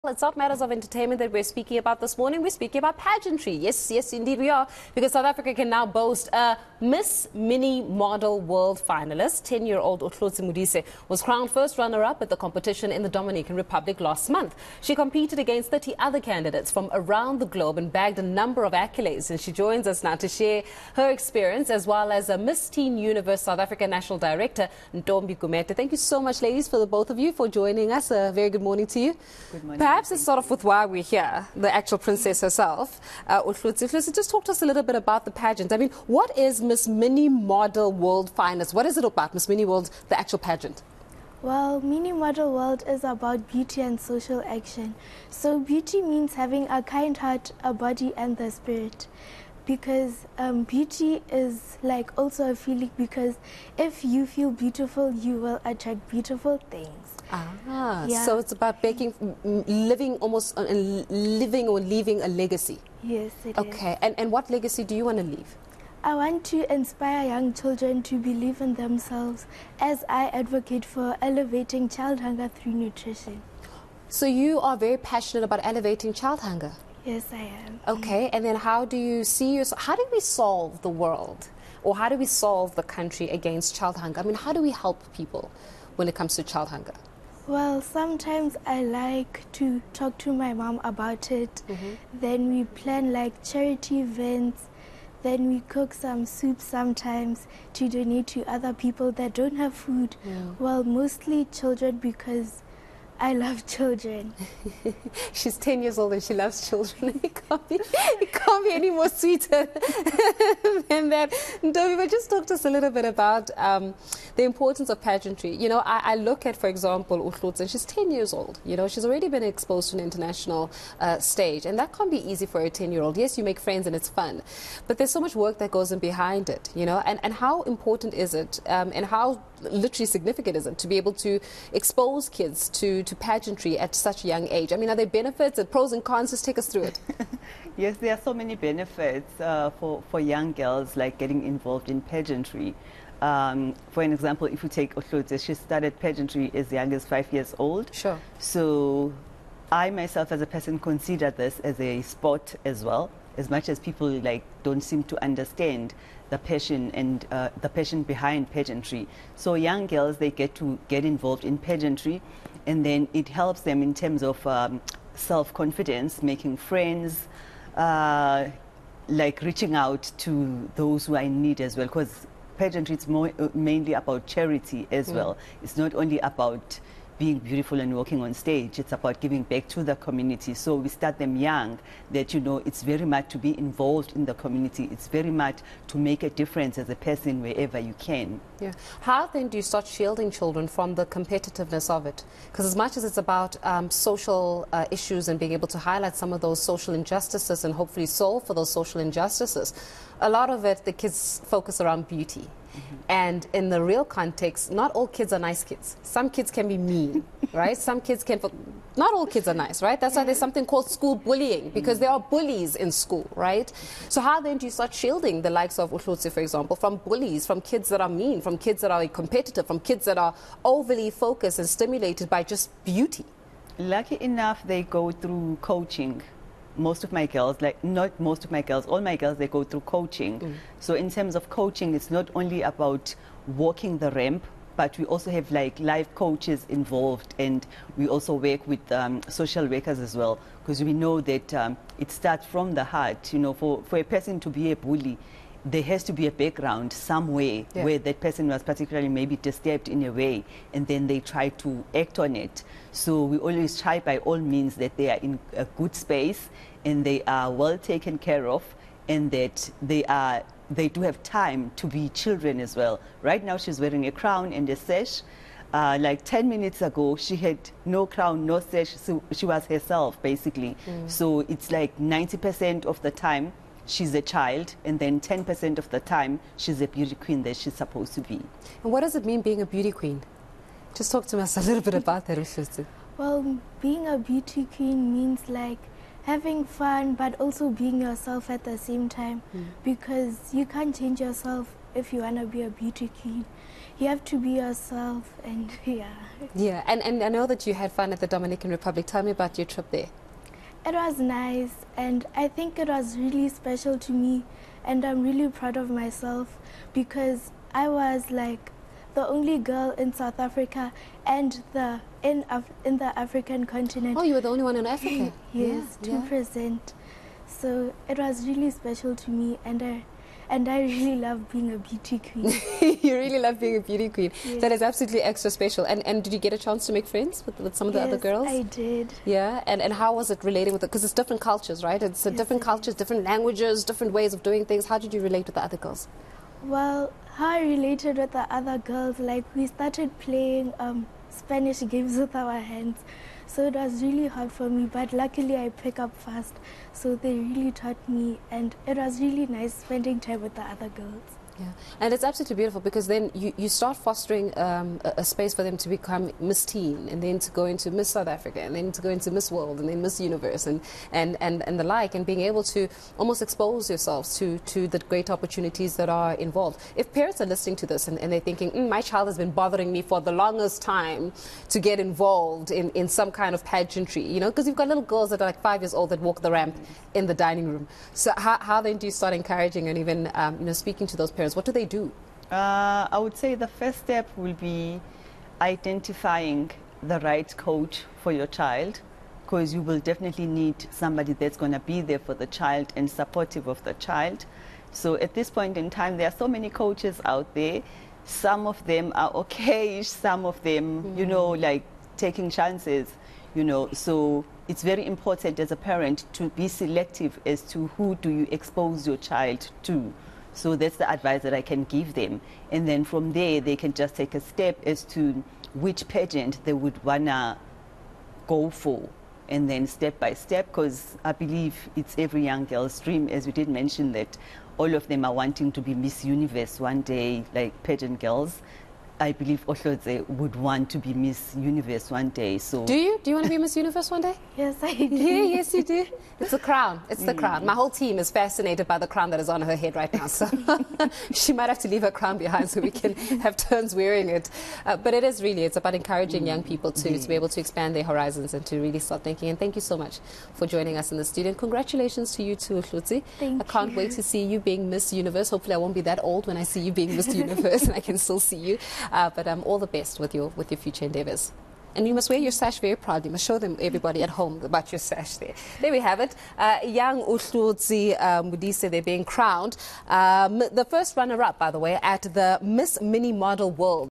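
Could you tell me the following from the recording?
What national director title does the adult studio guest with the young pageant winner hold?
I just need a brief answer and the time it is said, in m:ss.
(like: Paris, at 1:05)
Miss Teen Universe South Africa National Director, at 0:22.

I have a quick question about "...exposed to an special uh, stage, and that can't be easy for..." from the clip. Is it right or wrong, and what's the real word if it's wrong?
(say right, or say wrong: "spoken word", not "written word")
wrong: "international", not "special".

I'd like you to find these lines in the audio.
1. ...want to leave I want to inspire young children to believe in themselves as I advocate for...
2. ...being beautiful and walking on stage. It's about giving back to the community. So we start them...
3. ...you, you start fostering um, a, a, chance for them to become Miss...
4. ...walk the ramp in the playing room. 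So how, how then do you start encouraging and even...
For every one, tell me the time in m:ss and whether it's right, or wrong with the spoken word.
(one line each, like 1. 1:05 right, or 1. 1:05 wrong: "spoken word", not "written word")
1. 1:05 right
2. 2:57 right
3. 5:53 wrong: "space", not "chance"
4. 6:16 wrong: "dining", not "playing".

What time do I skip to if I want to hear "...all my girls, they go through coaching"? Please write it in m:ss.
3:48.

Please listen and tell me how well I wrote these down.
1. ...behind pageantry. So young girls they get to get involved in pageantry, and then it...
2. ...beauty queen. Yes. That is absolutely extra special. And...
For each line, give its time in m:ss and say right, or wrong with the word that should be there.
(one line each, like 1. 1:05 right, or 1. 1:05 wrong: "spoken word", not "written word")
1. 2:38 right
2. 5:23 right.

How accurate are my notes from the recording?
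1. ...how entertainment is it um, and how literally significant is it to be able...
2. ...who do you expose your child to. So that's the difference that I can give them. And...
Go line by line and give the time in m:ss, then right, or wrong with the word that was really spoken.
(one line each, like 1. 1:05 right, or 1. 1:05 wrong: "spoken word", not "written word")
1. 2:07 wrong: "important", not "entertainment"
2. 6:47 wrong: "advice", not "difference".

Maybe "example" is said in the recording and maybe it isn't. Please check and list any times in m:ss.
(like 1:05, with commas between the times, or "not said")
1:56, 2:24, 3:36.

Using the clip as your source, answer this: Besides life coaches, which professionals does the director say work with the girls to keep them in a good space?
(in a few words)
Social workers.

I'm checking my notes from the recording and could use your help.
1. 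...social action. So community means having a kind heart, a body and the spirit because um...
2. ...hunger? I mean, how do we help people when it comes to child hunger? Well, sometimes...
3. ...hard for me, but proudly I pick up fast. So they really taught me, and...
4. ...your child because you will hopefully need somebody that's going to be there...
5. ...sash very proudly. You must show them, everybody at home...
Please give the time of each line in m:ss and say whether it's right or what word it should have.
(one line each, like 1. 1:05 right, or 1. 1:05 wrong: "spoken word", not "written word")
1. 0:43 wrong: "beauty", not "community"
2. 1:23 right
3. 5:44 wrong: "luckily", not "proudly"
4. 6:28 wrong: "definitely", not "hopefully"
5. 7:42 right.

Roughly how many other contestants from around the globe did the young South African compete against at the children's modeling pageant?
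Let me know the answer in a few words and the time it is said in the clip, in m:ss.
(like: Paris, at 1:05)
30, at 0:15.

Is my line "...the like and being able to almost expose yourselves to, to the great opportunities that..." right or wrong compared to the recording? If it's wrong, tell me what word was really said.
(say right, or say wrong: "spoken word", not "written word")
right.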